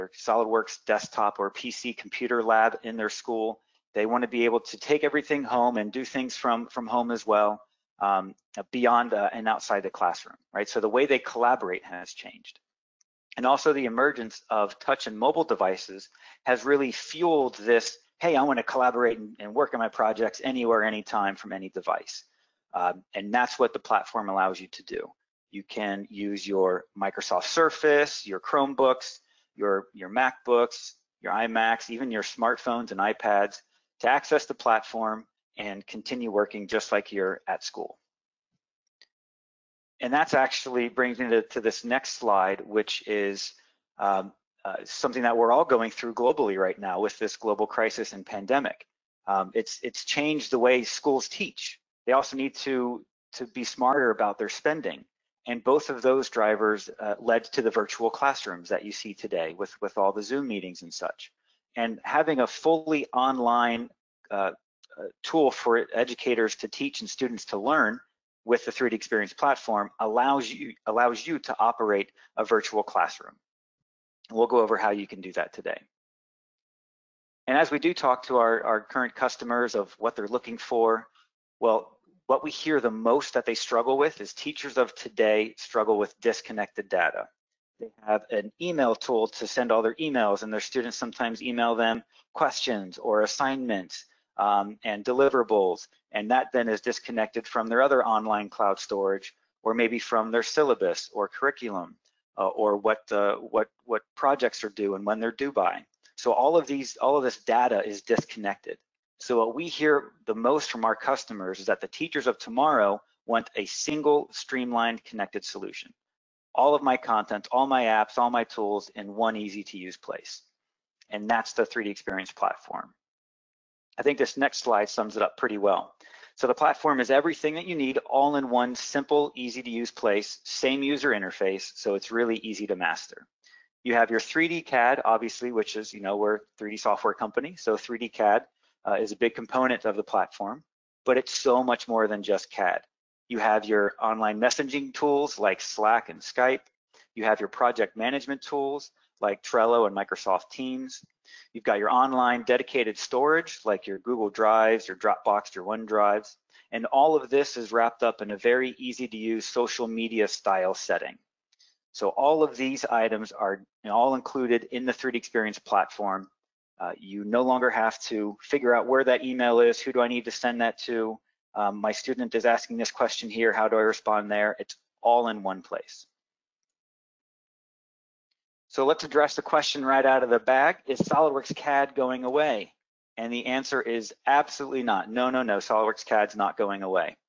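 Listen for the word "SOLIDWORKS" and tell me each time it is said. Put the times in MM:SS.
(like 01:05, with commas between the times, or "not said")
00:00, 03:00, 03:05.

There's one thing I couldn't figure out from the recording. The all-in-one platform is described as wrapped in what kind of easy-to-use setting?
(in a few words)
social media style.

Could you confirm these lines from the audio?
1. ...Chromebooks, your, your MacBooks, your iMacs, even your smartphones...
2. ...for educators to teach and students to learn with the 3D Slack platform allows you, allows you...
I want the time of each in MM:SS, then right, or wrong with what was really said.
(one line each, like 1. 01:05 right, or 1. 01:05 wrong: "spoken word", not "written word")
1. 00:28 right
2. 01:05 wrong: "Experience", not "Slack".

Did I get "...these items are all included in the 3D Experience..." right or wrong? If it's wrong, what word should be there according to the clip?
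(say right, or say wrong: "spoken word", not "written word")
right.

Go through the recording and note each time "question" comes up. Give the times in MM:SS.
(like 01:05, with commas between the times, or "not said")
01:32, 02:52, 02:59.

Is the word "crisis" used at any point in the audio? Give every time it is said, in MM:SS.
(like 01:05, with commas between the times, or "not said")
00:47.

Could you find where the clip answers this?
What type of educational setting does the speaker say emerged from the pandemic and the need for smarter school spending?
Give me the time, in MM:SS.
00:57.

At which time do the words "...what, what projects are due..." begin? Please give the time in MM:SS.
01:43.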